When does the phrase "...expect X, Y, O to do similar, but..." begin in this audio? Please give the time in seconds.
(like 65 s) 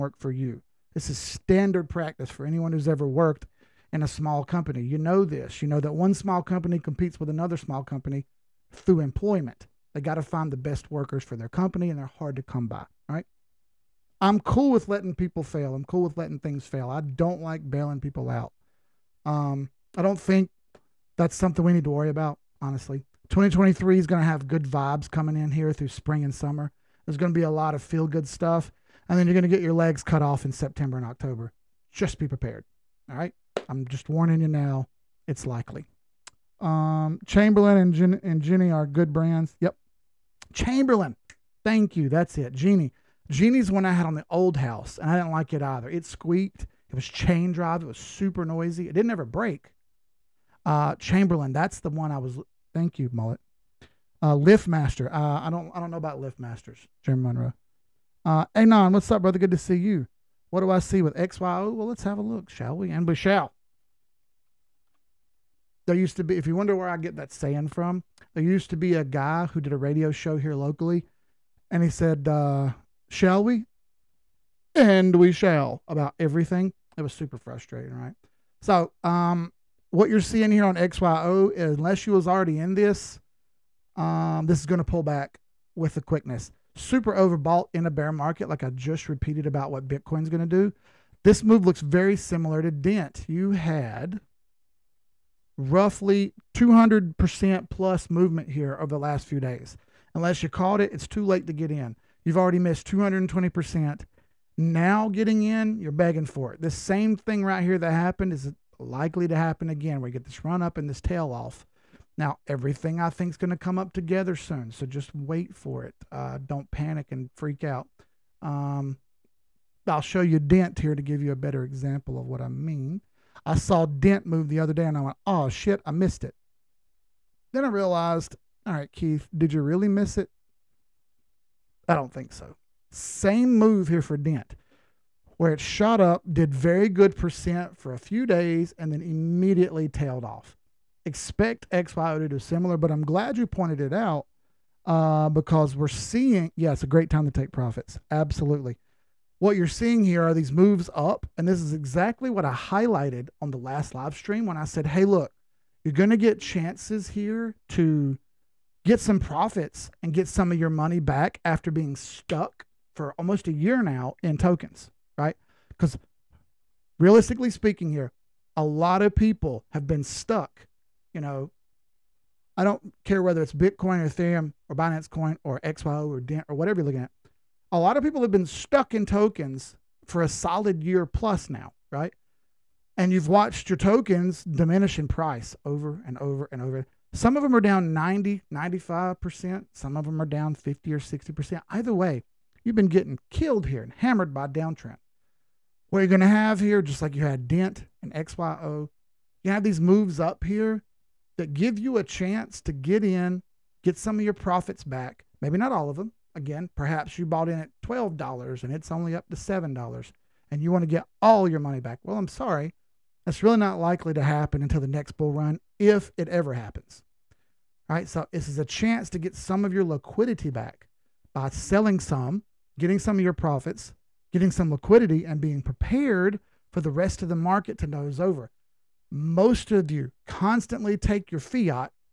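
141 s.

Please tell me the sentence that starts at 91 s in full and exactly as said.
This move looks very similar to Dent.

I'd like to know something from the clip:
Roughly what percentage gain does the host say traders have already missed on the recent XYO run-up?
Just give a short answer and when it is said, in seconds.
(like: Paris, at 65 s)
220%, at 102 s.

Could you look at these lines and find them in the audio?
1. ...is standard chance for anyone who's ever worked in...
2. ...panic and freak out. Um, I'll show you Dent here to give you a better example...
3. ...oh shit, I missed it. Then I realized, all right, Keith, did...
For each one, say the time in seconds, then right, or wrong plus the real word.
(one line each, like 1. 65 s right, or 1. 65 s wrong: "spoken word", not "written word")
1. 1 s wrong: "practice", not "chance"
2. 116 s right
3. 125 s right.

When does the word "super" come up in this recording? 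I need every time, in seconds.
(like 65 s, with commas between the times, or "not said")
47 s, 77 s, 86 s.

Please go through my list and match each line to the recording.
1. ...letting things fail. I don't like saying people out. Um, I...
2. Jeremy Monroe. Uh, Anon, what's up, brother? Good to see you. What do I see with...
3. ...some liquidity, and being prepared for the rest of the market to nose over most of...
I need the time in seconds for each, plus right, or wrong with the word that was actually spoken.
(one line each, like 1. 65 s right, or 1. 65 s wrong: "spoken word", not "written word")
1. 16 s wrong: "bailing", not "saying"
2. 57 s right
3. 224 s right.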